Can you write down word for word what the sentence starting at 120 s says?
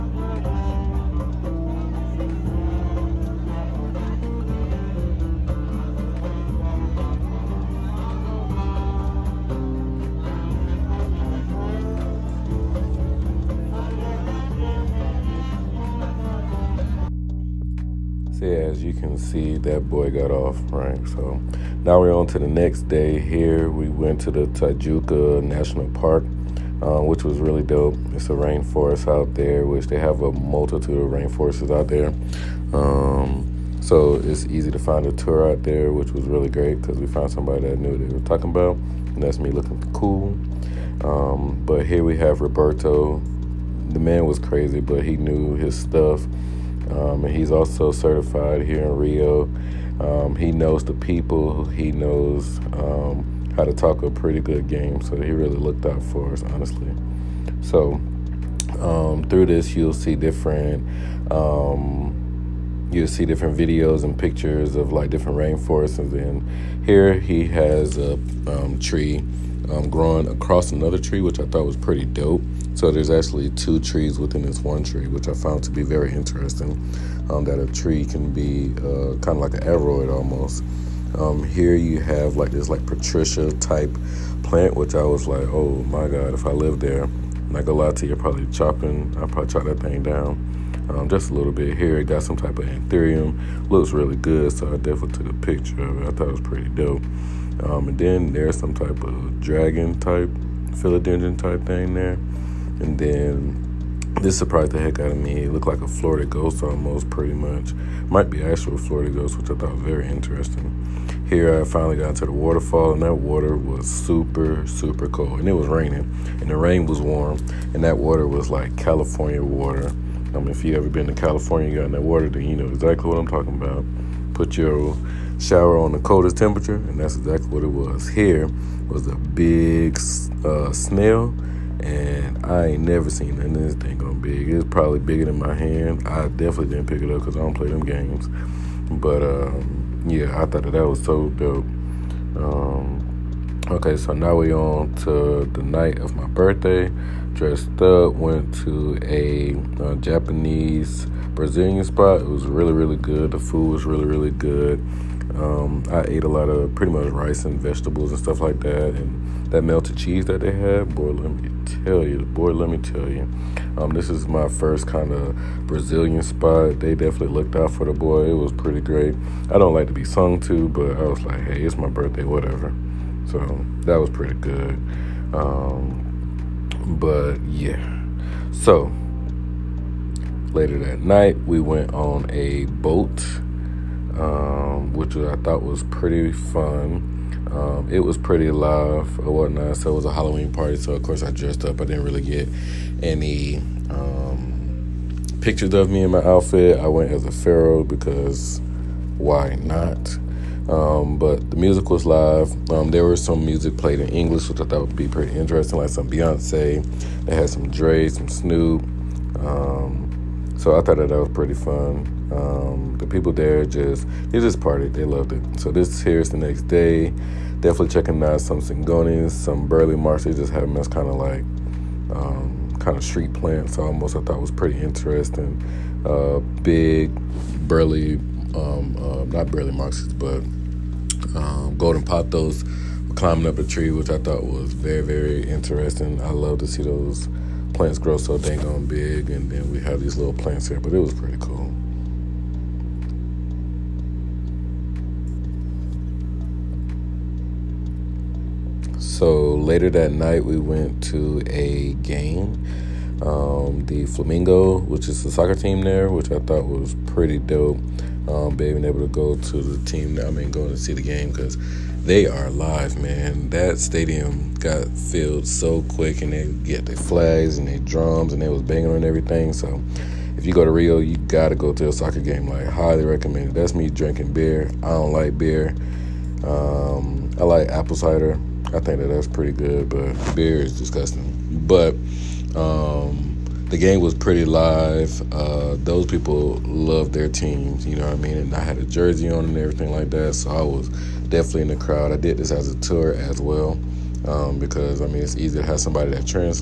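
I mean, if you ever been to California, you got in that water, then you know exactly what I'm talking about.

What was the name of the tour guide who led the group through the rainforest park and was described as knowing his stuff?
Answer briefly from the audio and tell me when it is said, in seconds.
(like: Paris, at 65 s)
Roberto, at 42 s.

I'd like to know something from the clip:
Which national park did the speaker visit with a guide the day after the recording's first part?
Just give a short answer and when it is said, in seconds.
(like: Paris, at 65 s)
Tijuca National Park, at 24 s.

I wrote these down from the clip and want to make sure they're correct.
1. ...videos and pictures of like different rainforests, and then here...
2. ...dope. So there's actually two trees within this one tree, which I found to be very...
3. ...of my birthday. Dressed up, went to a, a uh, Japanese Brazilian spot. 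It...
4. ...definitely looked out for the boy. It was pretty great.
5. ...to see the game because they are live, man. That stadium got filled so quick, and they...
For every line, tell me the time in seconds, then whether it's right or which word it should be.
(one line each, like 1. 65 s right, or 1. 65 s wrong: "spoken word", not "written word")
1. 63 s right
2. 72 s right
3. 145 s right
4. 166 s right
5. 260 s right.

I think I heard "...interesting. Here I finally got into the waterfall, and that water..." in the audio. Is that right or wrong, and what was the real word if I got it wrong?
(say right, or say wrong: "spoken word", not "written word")
right.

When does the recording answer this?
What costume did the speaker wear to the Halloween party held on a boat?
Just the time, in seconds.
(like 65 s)
197 s.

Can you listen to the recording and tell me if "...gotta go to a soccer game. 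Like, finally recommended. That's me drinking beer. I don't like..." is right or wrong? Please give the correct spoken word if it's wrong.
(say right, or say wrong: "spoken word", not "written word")
wrong: "highly", not "finally".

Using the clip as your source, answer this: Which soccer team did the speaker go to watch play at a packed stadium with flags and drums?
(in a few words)
Flamengo.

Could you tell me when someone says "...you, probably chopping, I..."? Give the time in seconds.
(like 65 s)
88 s.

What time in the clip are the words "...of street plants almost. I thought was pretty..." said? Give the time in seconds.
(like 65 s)
222 s.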